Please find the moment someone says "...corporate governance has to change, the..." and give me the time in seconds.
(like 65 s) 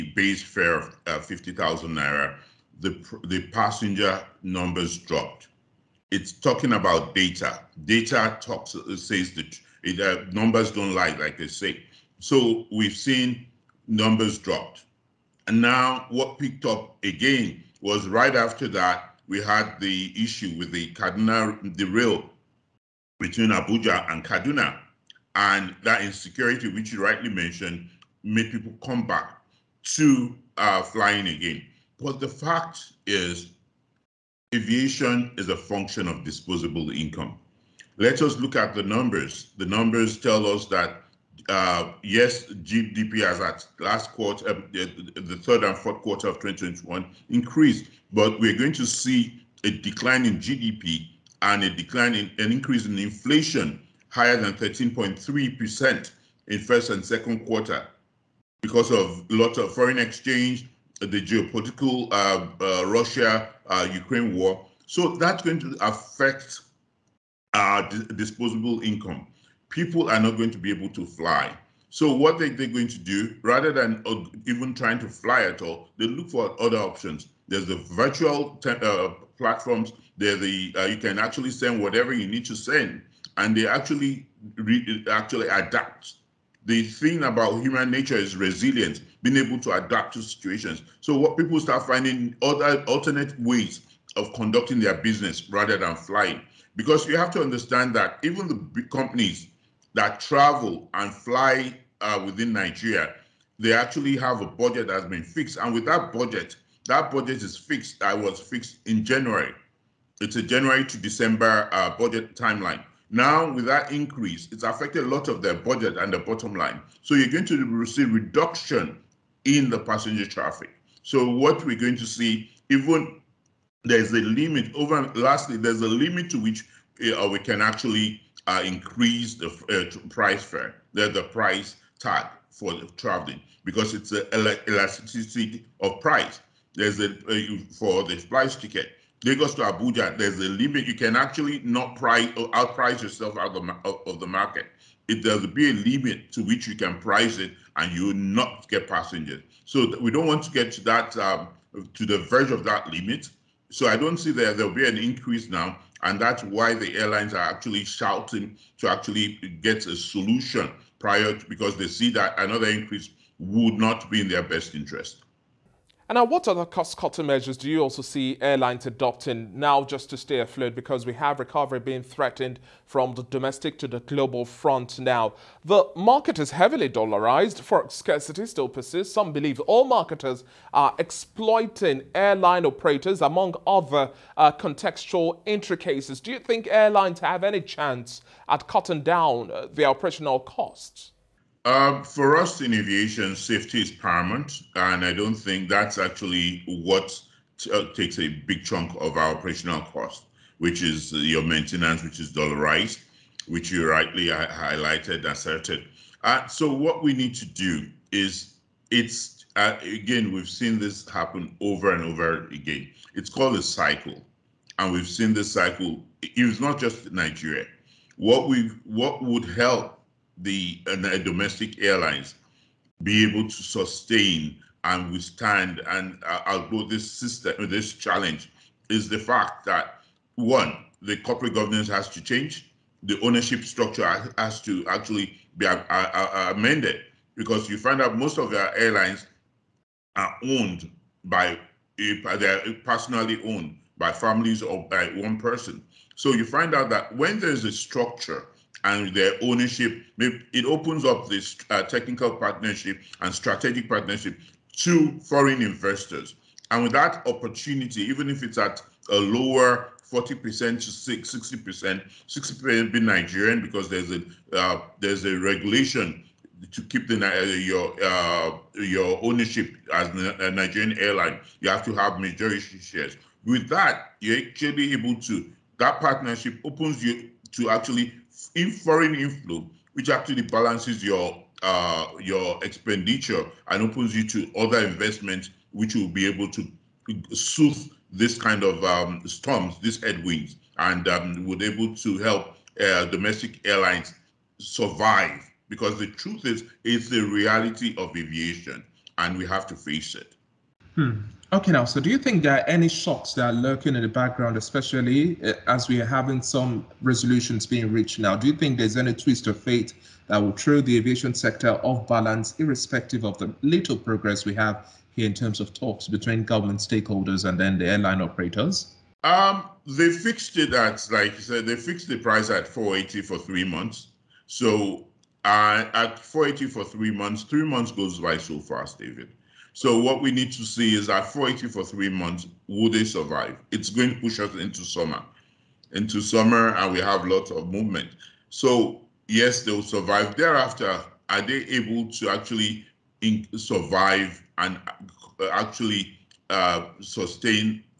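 231 s.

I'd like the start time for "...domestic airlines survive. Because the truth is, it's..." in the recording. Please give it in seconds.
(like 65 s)
293 s.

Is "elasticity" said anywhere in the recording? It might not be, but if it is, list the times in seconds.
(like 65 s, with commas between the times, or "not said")
134 s.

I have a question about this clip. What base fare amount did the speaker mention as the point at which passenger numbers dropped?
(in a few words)
50,000 naira.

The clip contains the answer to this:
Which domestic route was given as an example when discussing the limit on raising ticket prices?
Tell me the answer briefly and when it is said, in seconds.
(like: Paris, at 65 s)
Lagos to Abuja, at 139 s.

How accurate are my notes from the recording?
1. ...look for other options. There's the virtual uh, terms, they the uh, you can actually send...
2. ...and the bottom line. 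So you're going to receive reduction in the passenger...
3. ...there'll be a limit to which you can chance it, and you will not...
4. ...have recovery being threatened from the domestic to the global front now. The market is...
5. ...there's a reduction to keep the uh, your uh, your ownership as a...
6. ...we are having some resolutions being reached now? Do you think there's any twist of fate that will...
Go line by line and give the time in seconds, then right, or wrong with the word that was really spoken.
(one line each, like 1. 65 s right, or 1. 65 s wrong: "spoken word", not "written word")
1. 76 s wrong: "platforms", not "terms"
2. 115 s right
3. 145 s wrong: "price", not "chance"
4. 171 s right
5. 264 s wrong: "regulation", not "reduction"
6. 305 s right.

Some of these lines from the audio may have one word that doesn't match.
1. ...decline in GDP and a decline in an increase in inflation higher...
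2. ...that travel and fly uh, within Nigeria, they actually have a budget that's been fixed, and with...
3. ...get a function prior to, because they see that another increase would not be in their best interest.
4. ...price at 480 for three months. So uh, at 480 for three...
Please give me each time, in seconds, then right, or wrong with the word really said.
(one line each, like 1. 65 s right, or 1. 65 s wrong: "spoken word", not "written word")
1. 49 s right
2. 99 s right
3. 159 s wrong: "solution", not "function"
4. 322 s right.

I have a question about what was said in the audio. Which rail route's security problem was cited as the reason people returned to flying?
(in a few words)
Abuja and Kaduna.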